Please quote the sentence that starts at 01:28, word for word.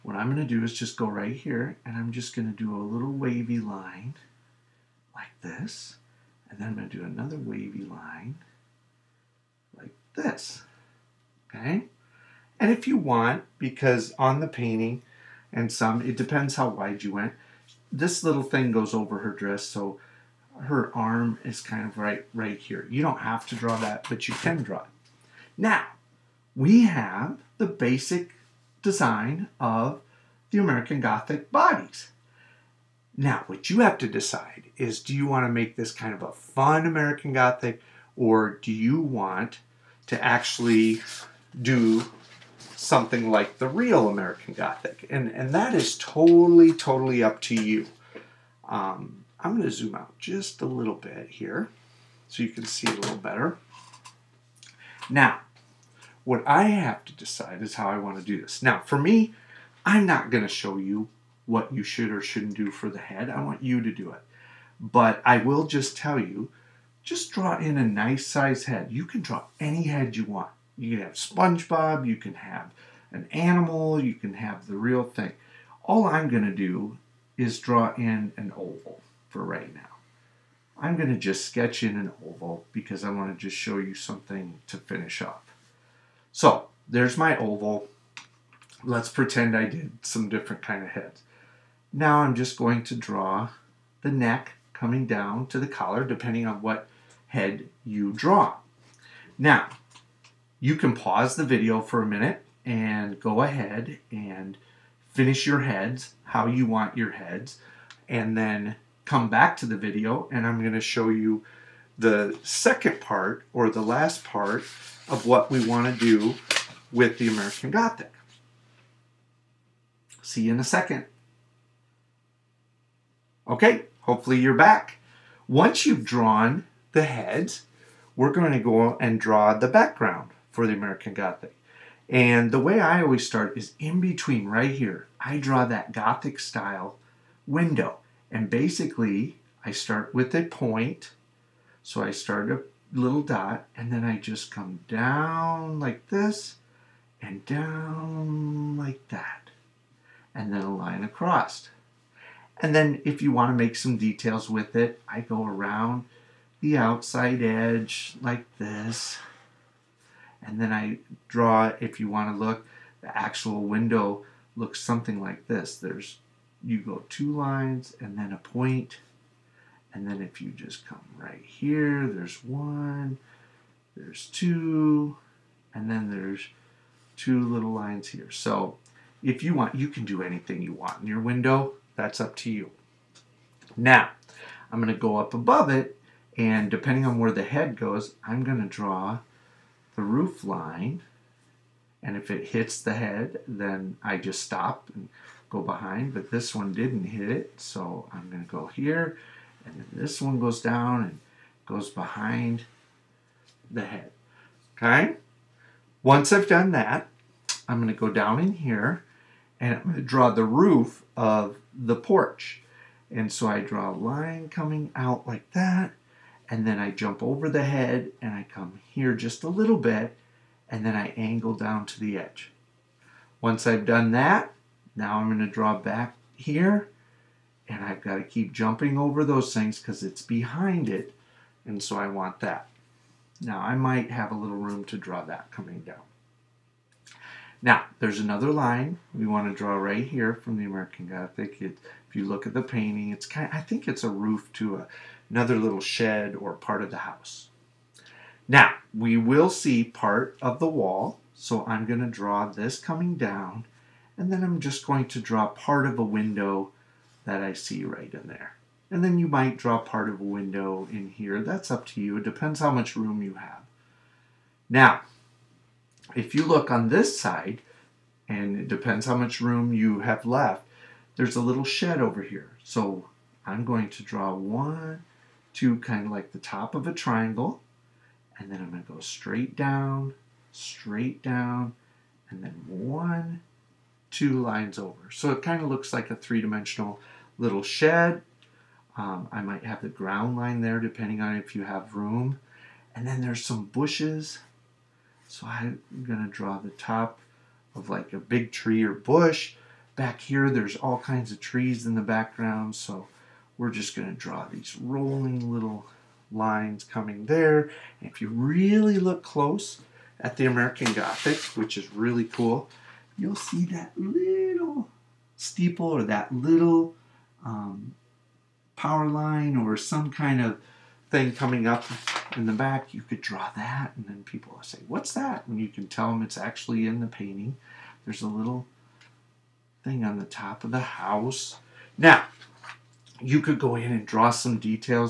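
Let's pretend I did some different kind of heads.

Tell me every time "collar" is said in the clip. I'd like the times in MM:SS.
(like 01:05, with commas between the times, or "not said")
01:35.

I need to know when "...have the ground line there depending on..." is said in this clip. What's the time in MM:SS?
04:49.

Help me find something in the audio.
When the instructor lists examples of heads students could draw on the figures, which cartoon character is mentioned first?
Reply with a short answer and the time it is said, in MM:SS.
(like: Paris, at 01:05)
SpongeBob, at 01:11.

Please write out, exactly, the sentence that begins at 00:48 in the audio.
Um, I'm going to zoom out just a little bit here so you can see it a little better.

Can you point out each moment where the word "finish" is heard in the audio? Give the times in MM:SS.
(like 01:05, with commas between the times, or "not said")
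01:24, 01:45.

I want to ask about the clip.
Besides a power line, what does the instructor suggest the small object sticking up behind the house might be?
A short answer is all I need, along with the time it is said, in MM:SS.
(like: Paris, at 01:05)
steeple, at 05:15.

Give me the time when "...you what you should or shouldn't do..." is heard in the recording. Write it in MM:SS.
01:00.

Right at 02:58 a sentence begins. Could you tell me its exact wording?
So if you want, you can do anything you want in your window.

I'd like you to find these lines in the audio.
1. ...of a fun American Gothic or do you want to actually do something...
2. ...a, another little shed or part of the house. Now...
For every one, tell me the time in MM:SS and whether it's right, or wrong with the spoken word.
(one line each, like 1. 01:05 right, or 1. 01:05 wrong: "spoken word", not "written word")
1. 00:36 right
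2. 04:04 right.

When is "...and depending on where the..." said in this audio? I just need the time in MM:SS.
03:06.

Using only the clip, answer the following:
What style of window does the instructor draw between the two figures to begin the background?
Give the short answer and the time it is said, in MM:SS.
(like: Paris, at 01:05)
Gothic style window, at 02:15.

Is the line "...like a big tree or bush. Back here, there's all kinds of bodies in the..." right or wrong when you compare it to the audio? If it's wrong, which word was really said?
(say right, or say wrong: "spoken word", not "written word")
wrong: "trees", not "bodies".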